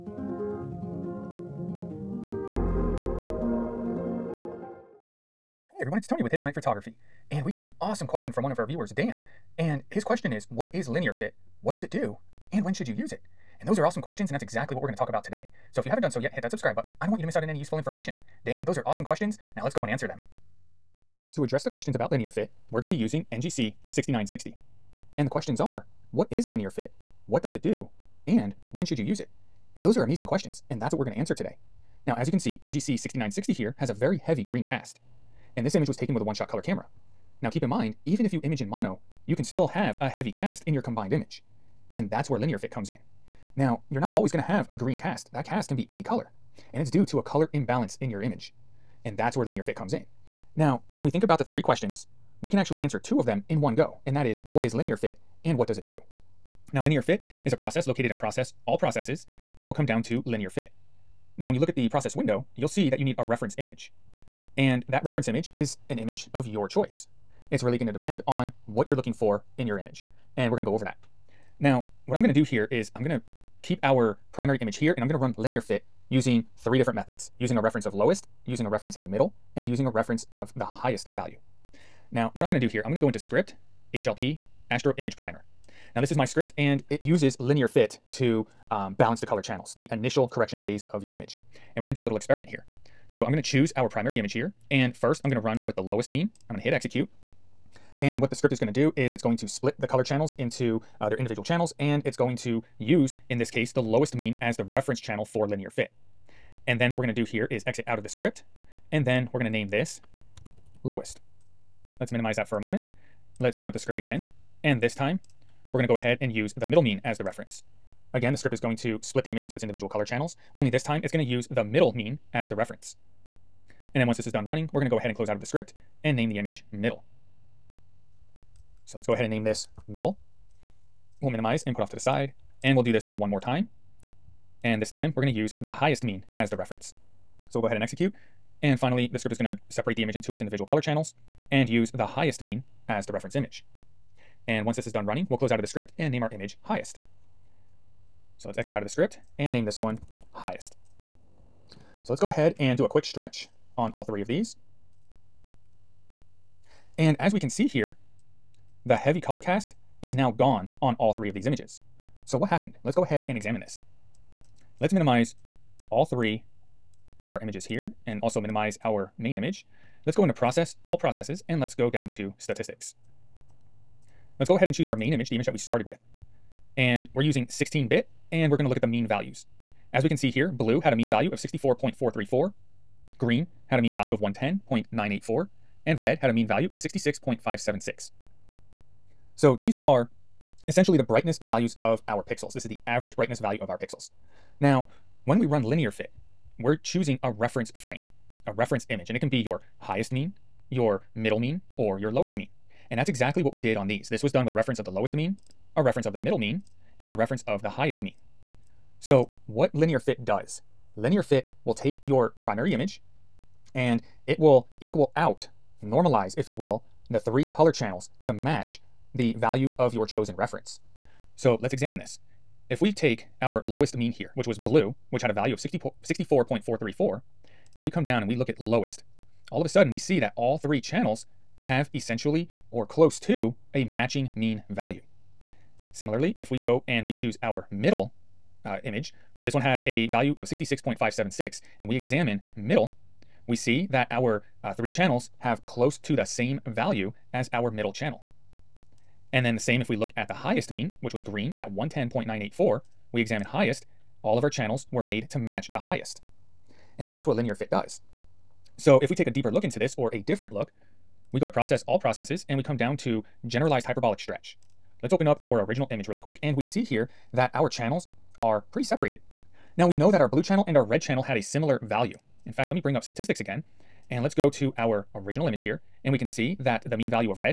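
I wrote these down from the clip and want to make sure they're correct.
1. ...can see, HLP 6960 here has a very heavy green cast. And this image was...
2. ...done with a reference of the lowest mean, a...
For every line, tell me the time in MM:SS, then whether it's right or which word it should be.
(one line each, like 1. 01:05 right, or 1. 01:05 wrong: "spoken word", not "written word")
1. 00:32 wrong: "NGC", not "HLP"
2. 03:24 right.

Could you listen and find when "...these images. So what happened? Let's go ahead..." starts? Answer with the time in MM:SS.
02:41.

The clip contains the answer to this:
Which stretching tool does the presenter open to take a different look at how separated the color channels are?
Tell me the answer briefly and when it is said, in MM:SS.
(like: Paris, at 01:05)
Generalized hyperbolic stretch, at 04:23.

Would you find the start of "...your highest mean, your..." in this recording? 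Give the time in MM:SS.
03:19.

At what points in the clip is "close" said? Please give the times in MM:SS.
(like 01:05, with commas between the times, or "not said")
02:05, 02:25, 03:52, 04:05.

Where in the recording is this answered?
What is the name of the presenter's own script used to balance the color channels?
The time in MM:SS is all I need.
01:23.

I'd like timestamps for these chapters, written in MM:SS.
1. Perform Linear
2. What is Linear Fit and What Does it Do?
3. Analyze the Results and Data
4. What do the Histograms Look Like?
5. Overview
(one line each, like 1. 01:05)
1. 01:21
2. 00:49
3. 02:31
4. 04:18
5. 00:20.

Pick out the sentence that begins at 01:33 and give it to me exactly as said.
So I'm going to choose our primary image here.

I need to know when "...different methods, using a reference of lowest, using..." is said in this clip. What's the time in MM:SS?
01:16.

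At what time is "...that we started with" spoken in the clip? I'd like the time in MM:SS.
02:55.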